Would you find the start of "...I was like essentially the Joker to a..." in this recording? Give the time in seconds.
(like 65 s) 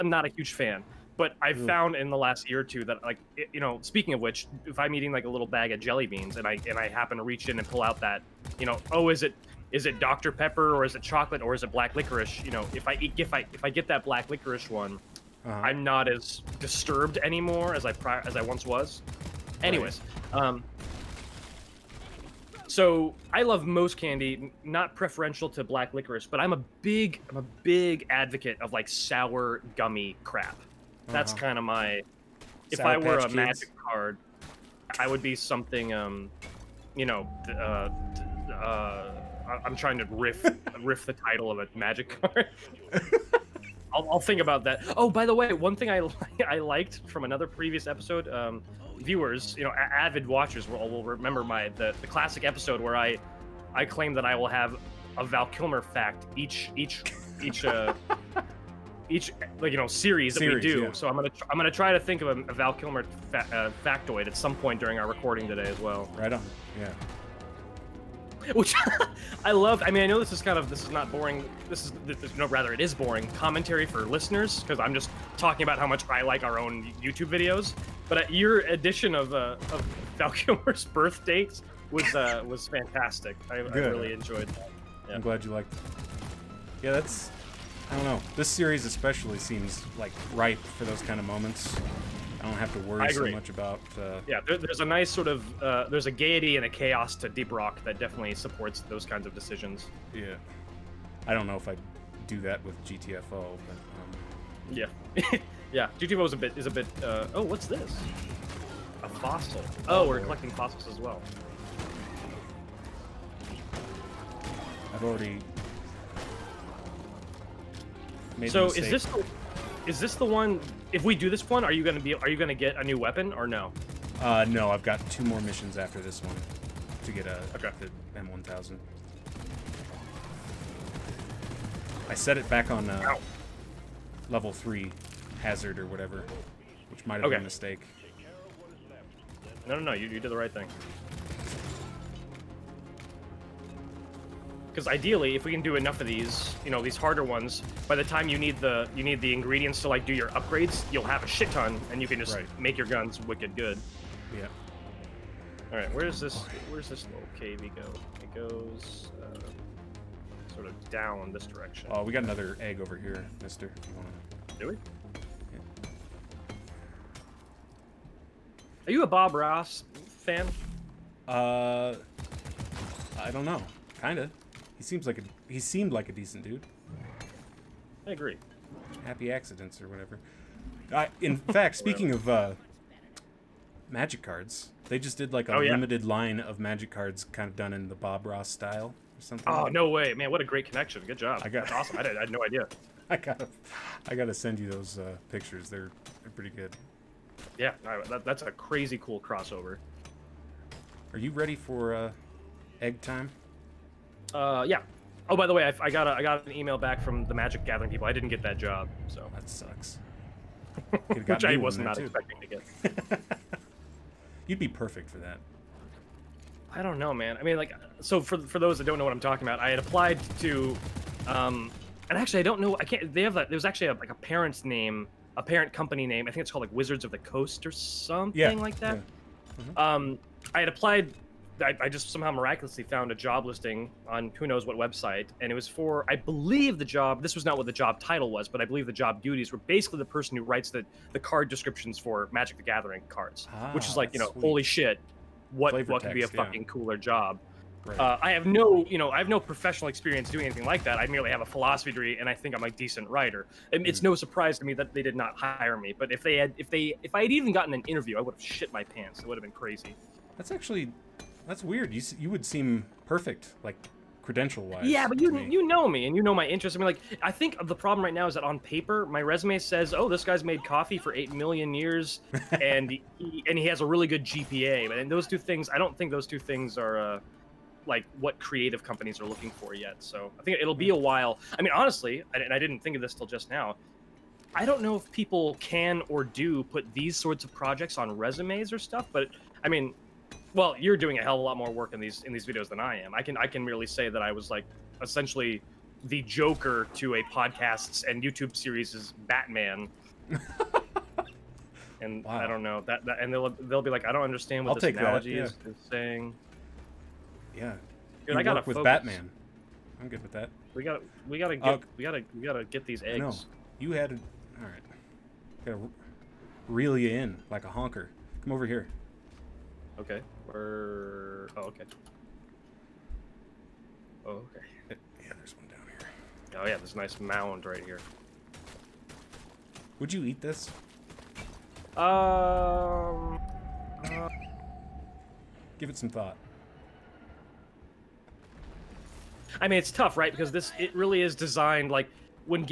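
294 s.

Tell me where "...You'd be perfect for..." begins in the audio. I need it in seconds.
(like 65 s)
214 s.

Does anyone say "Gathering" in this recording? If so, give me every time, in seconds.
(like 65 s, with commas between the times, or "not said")
207 s, 242 s.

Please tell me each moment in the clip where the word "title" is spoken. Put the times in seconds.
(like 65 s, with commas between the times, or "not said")
41 s, 237 s.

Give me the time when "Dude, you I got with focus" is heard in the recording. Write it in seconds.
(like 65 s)
308 s.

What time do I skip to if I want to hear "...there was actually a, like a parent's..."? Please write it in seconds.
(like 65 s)
223 s.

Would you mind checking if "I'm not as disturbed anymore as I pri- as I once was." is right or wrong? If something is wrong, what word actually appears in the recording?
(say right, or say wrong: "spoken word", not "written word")
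right.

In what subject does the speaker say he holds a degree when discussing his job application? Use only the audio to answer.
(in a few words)
Philosophy.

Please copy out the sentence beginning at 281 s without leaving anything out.
I mean, honestly, and I didn't think of this till just now.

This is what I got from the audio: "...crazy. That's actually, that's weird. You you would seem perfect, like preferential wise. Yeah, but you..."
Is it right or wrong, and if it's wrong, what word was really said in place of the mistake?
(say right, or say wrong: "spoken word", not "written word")
wrong: "credential", not "preferential".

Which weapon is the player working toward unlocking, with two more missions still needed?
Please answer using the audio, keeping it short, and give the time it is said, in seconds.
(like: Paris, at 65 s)
M1000, at 128 s.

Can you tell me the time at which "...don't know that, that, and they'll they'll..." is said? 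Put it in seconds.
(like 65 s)
302 s.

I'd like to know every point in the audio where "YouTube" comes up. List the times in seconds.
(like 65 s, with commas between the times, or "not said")
77 s, 298 s.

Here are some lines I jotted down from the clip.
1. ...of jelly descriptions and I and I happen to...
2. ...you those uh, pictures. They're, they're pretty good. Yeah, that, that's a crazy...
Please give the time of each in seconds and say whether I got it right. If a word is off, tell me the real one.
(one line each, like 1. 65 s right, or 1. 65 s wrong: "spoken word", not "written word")
1. 5 s wrong: "beans", not "descriptions"
2. 194 s right.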